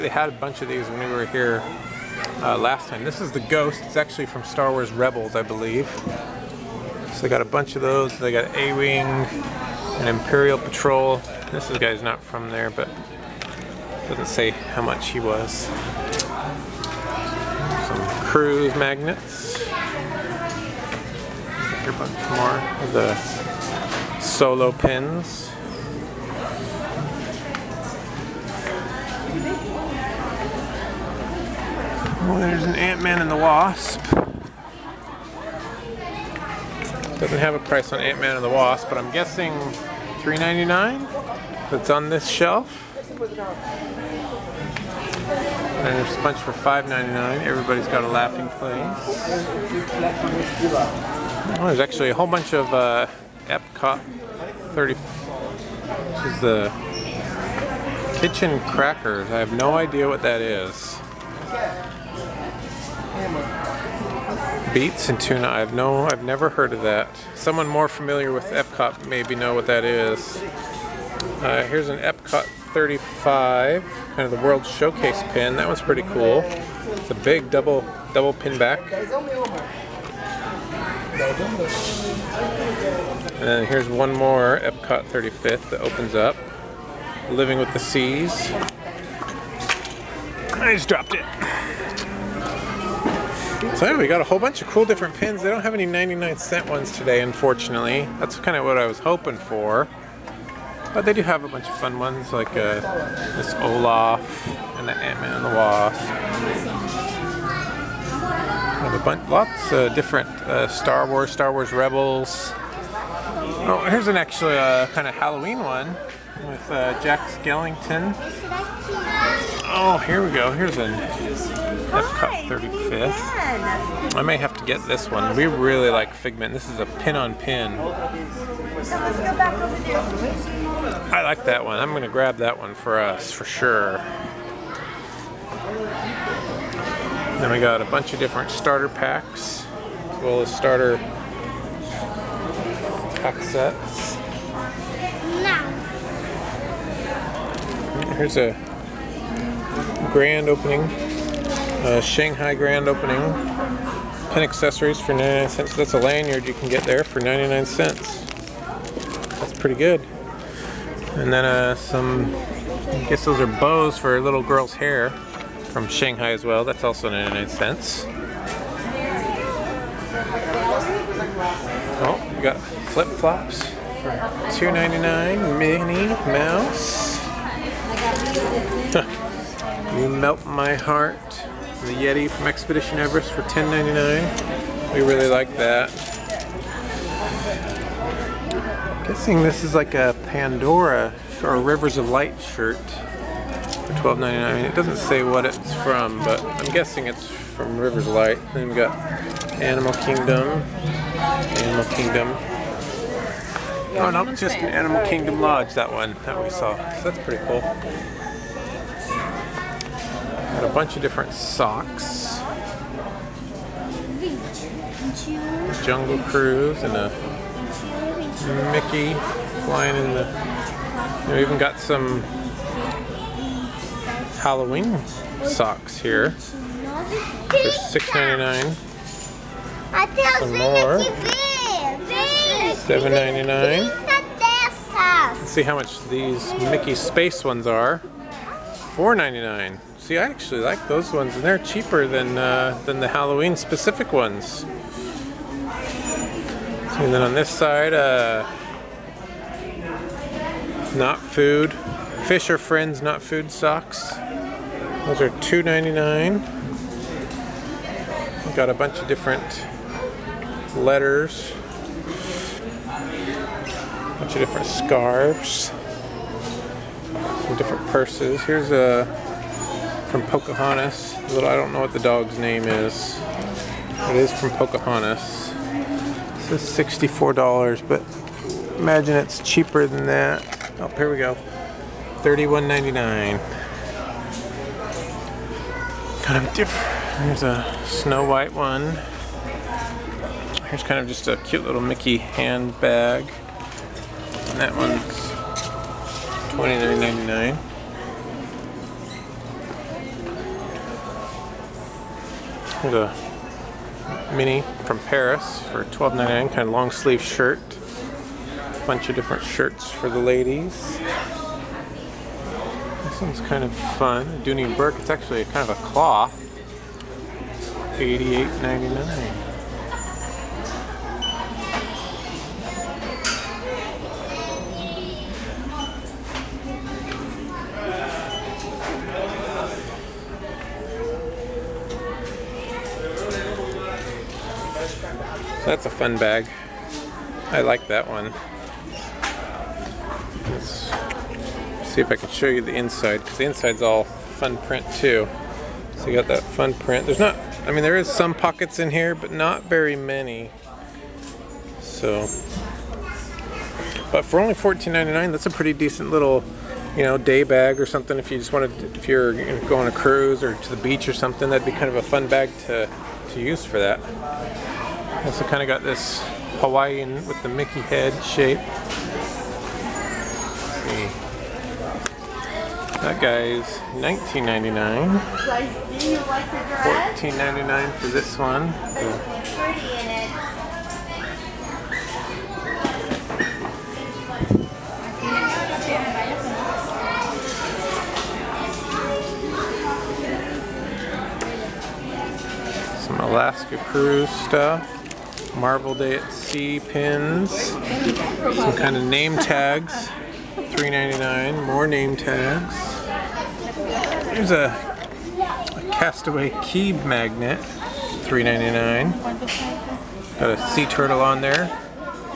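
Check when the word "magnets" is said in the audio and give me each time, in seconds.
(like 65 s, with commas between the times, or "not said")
18 s, 407 s.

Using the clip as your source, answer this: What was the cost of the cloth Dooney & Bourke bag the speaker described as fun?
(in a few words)
$88.99.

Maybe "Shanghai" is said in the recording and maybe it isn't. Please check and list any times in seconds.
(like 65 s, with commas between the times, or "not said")
152 s, 165 s.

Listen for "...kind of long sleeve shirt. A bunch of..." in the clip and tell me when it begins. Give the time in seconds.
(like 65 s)
306 s.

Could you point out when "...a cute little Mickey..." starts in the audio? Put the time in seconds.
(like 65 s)
291 s.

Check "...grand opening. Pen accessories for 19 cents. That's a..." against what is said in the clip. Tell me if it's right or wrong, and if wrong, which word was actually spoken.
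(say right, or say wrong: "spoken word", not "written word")
wrong: "99", not "19".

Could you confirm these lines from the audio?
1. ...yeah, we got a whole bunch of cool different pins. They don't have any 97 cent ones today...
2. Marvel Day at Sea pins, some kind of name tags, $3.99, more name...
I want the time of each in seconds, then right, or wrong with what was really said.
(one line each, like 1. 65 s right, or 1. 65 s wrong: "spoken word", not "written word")
1. 93 s wrong: "99", not "97"
2. 395 s right.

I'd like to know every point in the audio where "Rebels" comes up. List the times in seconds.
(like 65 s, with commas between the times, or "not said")
4 s, 111 s.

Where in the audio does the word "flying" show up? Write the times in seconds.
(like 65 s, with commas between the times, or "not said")
219 s.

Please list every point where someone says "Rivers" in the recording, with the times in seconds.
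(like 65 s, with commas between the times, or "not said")
191 s, 197 s.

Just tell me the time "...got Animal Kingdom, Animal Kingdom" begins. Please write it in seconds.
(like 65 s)
198 s.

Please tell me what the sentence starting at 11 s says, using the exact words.
This guy's not from there, but doesn't say how much he was.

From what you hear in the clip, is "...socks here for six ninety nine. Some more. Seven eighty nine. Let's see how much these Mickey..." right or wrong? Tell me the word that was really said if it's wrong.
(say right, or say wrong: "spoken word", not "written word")
wrong: "ninety", not "eighty".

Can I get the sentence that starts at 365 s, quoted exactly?
Also kind of got this Hawaiian with the Mickey head shape.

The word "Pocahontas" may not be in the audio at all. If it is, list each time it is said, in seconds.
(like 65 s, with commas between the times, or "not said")
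270 s, 274 s.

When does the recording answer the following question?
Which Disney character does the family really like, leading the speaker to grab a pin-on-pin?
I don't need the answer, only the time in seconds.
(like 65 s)
126 s.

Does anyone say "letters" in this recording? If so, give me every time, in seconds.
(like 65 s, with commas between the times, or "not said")
260 s.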